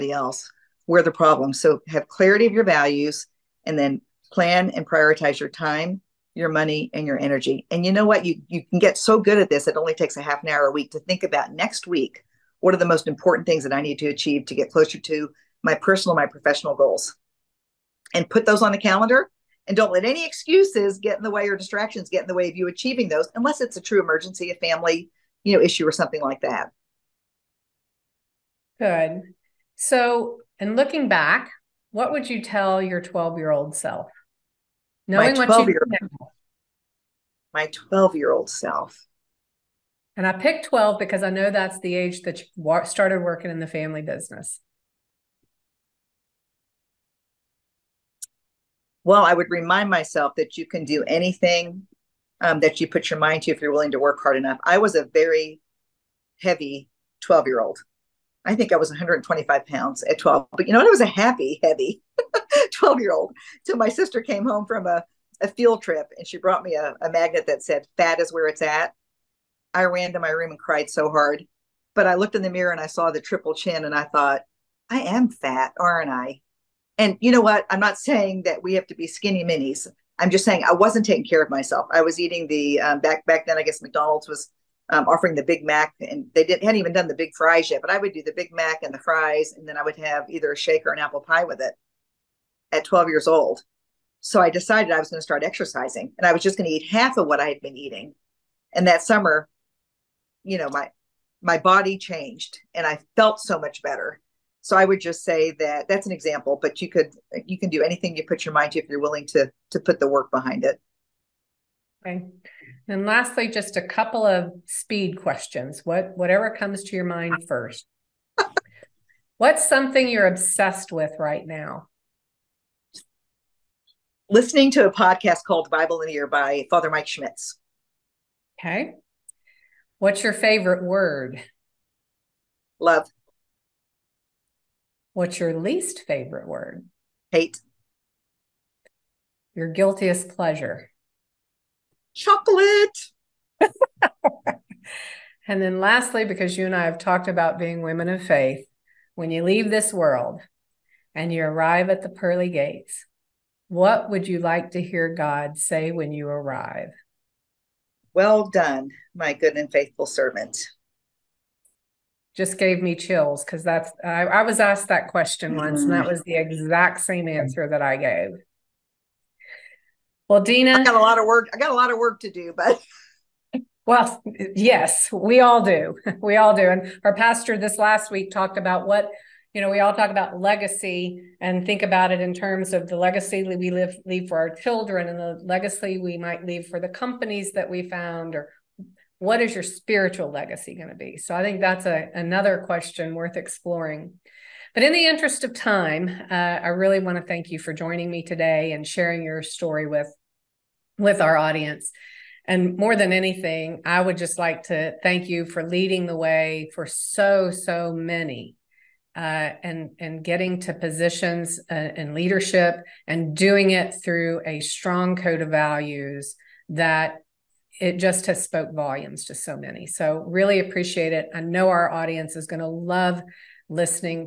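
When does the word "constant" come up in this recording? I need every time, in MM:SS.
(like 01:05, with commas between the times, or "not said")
not said.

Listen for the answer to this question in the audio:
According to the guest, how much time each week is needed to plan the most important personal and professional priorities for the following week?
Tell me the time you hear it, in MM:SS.
00:10.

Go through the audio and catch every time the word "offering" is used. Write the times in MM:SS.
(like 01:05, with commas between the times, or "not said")
01:25.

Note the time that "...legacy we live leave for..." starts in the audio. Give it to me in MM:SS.
03:02.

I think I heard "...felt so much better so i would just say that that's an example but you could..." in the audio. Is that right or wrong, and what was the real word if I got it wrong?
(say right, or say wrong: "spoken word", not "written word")
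right.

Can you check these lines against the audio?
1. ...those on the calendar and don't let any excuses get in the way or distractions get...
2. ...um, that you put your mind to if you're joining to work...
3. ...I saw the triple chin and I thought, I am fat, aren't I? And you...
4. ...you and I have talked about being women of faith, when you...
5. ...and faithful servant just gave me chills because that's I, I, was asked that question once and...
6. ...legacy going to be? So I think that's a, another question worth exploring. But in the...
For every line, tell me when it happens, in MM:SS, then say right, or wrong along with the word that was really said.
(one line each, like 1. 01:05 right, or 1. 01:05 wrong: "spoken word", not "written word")
1. 00:18 right
2. 00:52 wrong: "willing", not "joining"
3. 01:12 right
4. 02:26 right
5. 02:39 right
6. 03:10 right.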